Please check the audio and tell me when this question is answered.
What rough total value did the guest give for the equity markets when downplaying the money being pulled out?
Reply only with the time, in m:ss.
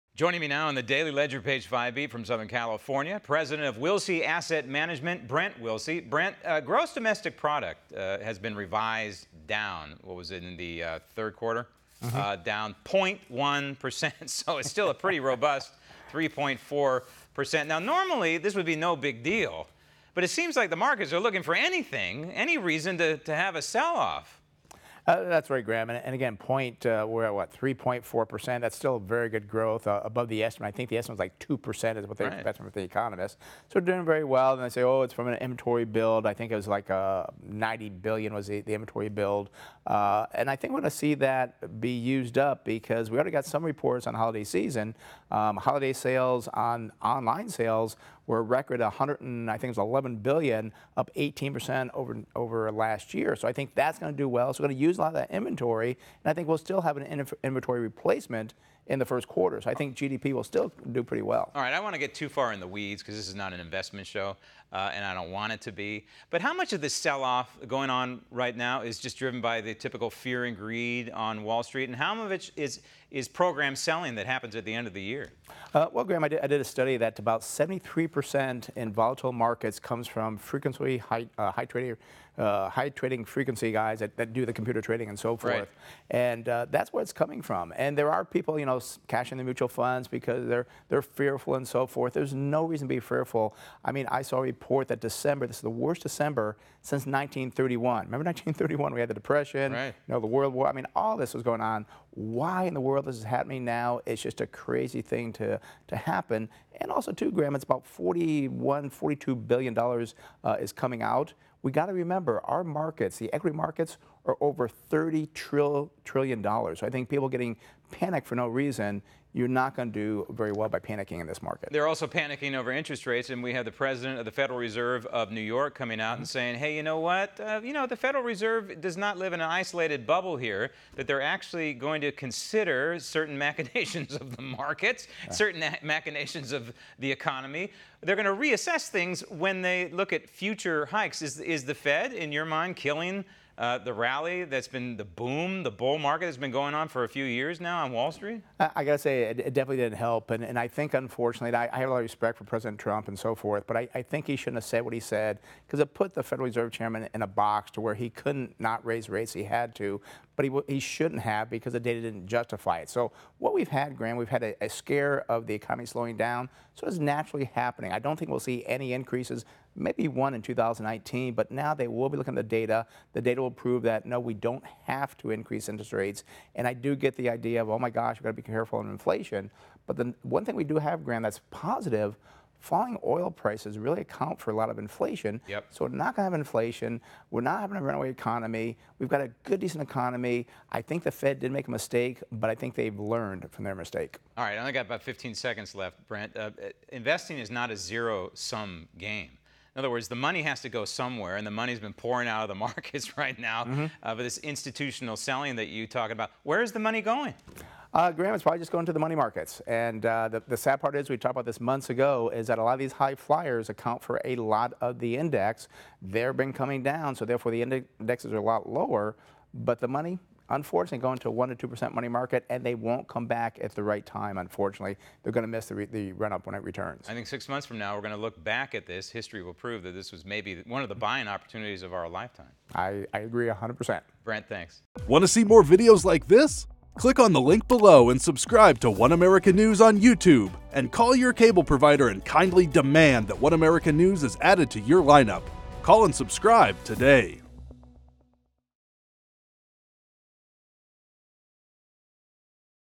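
1:54.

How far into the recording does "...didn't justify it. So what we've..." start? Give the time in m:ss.
2:42.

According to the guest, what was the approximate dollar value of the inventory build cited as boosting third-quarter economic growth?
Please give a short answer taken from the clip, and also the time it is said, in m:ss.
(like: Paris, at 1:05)
90 billion, at 0:36.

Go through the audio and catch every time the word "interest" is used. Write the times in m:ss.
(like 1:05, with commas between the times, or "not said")
2:02, 2:55.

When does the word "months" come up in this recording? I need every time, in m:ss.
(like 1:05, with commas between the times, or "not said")
3:31, 3:47.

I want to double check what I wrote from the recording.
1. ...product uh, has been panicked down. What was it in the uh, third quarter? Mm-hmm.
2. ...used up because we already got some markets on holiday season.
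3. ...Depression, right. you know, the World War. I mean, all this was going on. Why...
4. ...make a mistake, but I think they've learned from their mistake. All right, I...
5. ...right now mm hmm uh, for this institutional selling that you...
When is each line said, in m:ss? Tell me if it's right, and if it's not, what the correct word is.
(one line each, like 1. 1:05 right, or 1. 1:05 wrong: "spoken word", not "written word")
1. 0:07 wrong: "revised", not "panicked"
2. 0:41 wrong: "reports", not "markets"
3. 1:39 right
4. 3:11 right
5. 3:23 right.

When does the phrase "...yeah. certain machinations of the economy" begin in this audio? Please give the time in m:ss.
2:15.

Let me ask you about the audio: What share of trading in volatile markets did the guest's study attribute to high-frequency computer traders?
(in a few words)
73%.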